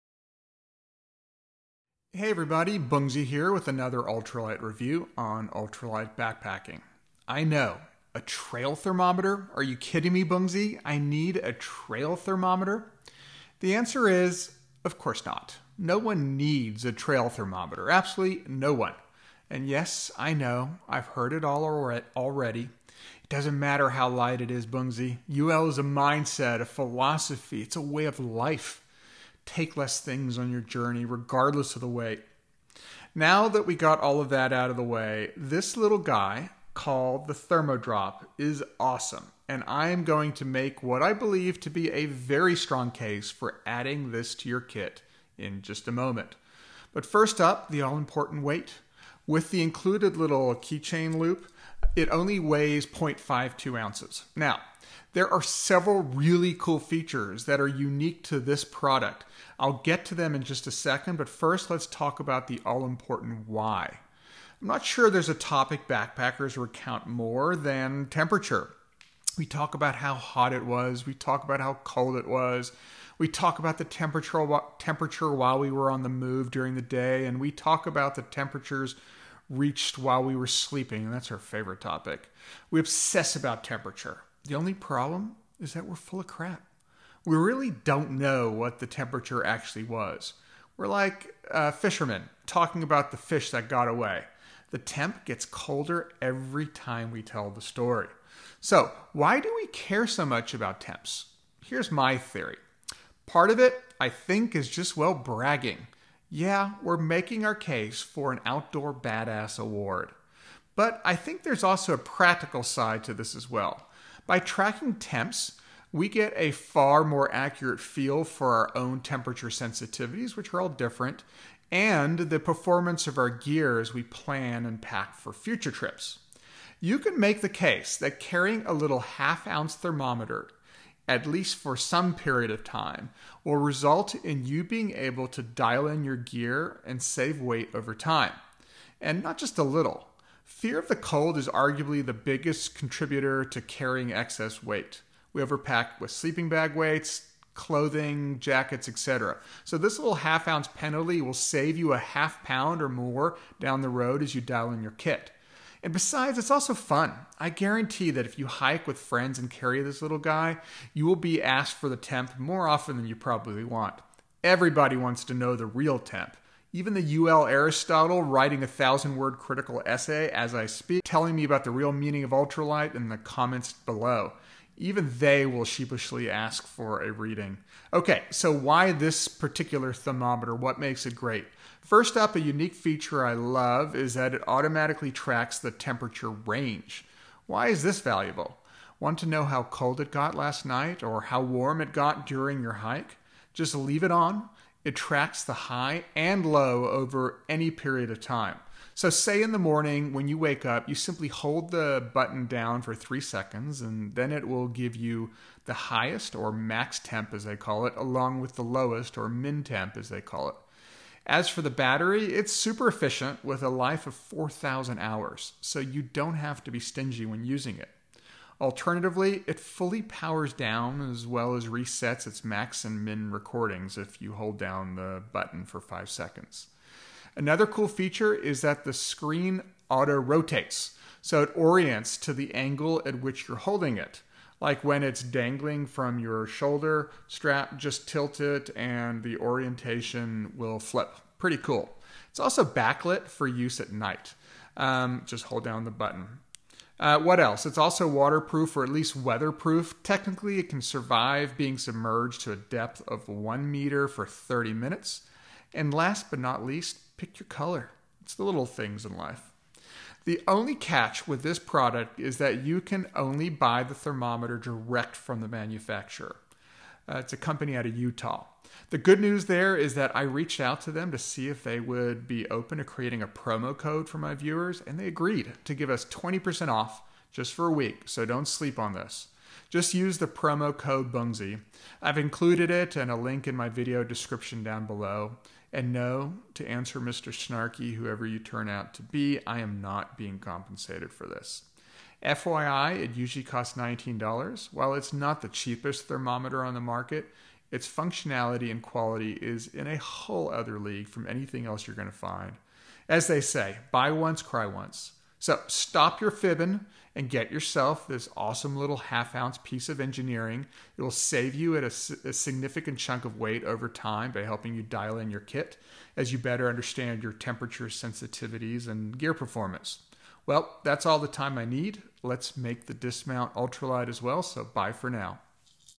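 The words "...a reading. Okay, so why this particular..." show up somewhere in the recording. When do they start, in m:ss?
2:57.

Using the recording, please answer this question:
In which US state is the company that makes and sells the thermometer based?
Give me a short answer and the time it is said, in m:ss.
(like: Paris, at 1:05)
Utah, at 4:27.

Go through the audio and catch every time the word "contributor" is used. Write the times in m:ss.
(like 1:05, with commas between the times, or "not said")
2:22.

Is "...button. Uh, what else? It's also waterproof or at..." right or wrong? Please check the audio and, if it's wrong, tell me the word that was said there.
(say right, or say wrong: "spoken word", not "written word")
right.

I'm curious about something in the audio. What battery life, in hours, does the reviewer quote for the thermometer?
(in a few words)
4,000 hours.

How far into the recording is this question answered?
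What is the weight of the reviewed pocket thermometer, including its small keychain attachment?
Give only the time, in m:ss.
0:52.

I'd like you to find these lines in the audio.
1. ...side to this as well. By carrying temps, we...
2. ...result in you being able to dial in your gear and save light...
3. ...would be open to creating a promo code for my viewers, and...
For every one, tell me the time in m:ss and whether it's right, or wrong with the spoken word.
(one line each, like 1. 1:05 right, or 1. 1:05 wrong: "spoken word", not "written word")
1. 1:52 wrong: "tracking", not "carrying"
2. 2:13 wrong: "weight", not "light"
3. 4:31 right.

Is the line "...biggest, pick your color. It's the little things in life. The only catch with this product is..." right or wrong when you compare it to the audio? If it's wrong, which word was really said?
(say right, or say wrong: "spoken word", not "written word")
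wrong: "least", not "biggest".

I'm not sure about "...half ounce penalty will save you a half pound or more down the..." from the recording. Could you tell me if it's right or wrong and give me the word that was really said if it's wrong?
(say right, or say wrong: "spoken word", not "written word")
right.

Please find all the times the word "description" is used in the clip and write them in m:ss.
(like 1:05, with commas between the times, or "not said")
4:44.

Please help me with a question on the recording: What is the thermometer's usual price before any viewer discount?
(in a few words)
$19.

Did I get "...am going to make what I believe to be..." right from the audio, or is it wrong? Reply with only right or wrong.
right.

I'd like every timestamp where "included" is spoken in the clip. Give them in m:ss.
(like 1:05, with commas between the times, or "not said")
0:49, 4:42.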